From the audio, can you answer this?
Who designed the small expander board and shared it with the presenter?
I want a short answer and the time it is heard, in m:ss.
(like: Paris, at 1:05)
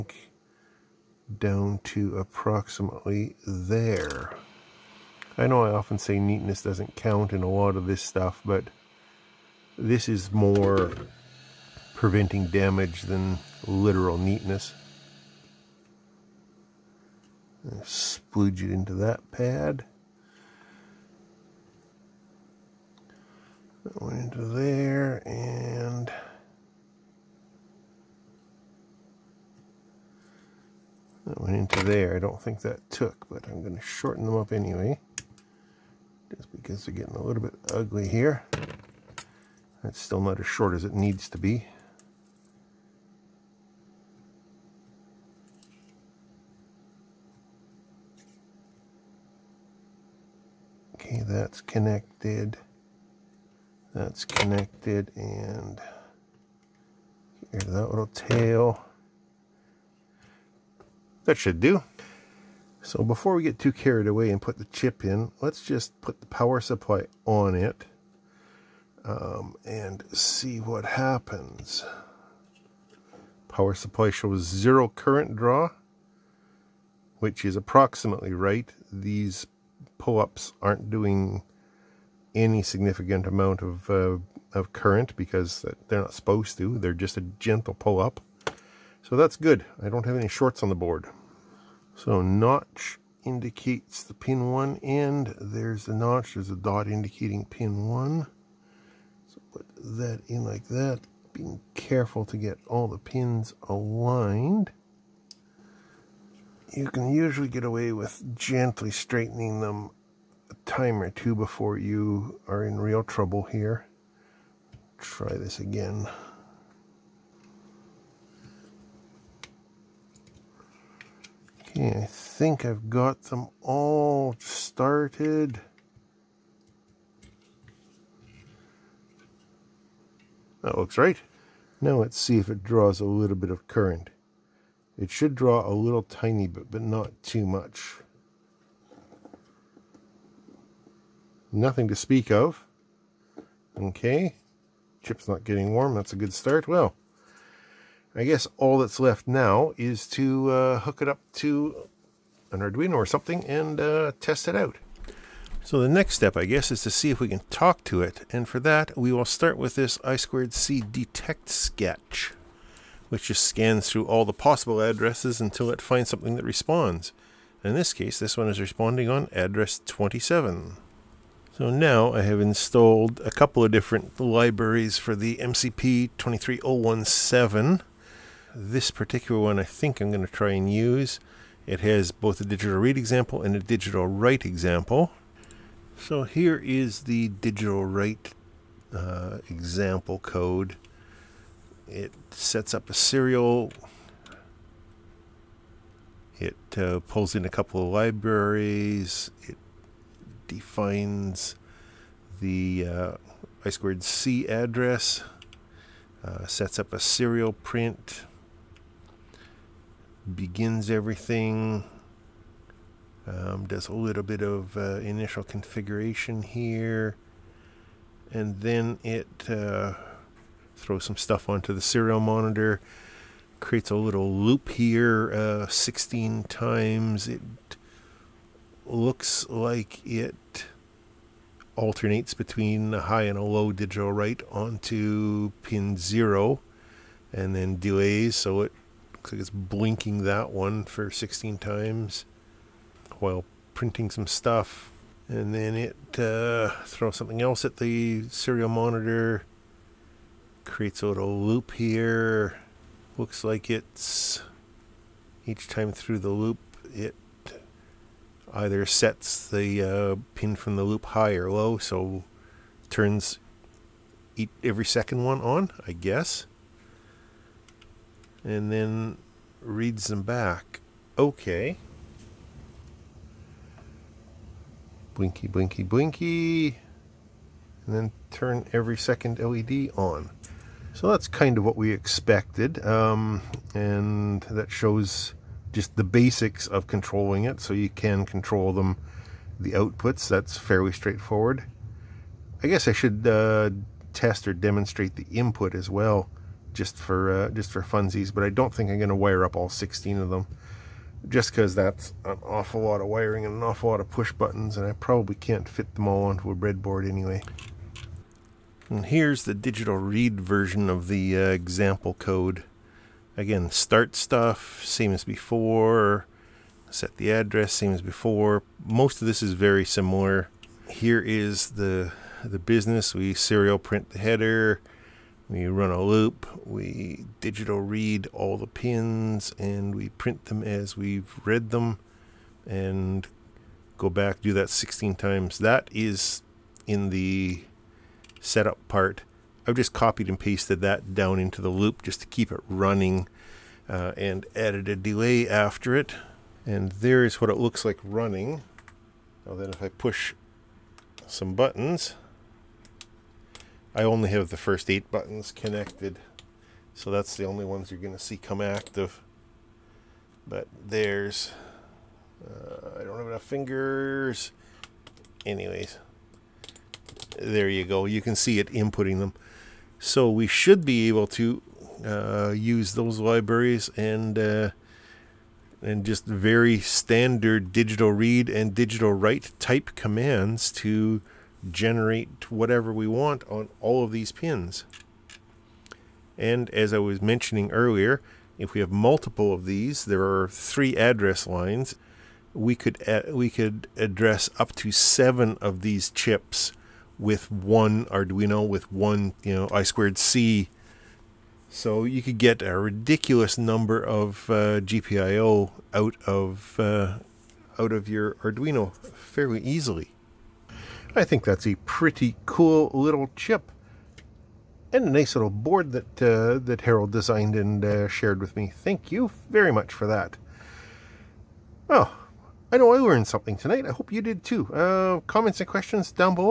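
Harold, at 6:56.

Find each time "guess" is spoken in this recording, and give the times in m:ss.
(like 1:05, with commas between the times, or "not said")
2:28, 2:36, 4:25, 4:52.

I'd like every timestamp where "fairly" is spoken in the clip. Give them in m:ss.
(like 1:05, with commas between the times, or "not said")
4:50, 6:49.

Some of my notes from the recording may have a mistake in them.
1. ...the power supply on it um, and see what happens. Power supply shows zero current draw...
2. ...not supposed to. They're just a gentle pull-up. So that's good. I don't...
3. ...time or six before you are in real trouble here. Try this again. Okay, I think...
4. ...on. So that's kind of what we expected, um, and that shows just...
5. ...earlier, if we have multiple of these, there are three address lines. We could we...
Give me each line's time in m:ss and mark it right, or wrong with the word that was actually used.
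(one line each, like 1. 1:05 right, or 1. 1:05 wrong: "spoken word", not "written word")
1. 1:06 right
2. 1:26 right
3. 1:50 wrong: "two", not "six"
4. 4:39 right
5. 6:27 right.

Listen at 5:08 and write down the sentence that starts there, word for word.
And here's the digital read version of the uh, example code.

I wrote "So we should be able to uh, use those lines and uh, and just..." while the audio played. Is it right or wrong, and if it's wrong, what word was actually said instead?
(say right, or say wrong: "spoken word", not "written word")
wrong: "libraries", not "lines".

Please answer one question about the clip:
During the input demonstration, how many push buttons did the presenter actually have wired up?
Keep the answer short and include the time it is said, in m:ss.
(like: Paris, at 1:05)
8, at 5:54.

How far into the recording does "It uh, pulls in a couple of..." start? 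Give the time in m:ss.
3:16.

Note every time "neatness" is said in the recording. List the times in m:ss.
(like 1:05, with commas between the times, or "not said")
0:06, 0:14.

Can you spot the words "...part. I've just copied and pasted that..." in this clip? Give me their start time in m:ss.
5:38.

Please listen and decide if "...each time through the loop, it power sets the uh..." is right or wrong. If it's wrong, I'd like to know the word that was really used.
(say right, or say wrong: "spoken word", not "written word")
wrong: "either", not "power".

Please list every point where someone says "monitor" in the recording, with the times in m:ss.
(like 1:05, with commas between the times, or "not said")
3:42, 4:08.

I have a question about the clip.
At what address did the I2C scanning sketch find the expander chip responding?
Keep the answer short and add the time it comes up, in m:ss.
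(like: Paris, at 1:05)
27, at 2:49.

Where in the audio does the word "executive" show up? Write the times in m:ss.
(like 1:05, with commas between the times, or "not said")
not said.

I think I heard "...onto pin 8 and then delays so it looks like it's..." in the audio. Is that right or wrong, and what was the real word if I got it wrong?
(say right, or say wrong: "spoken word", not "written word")
wrong: "0", not "8".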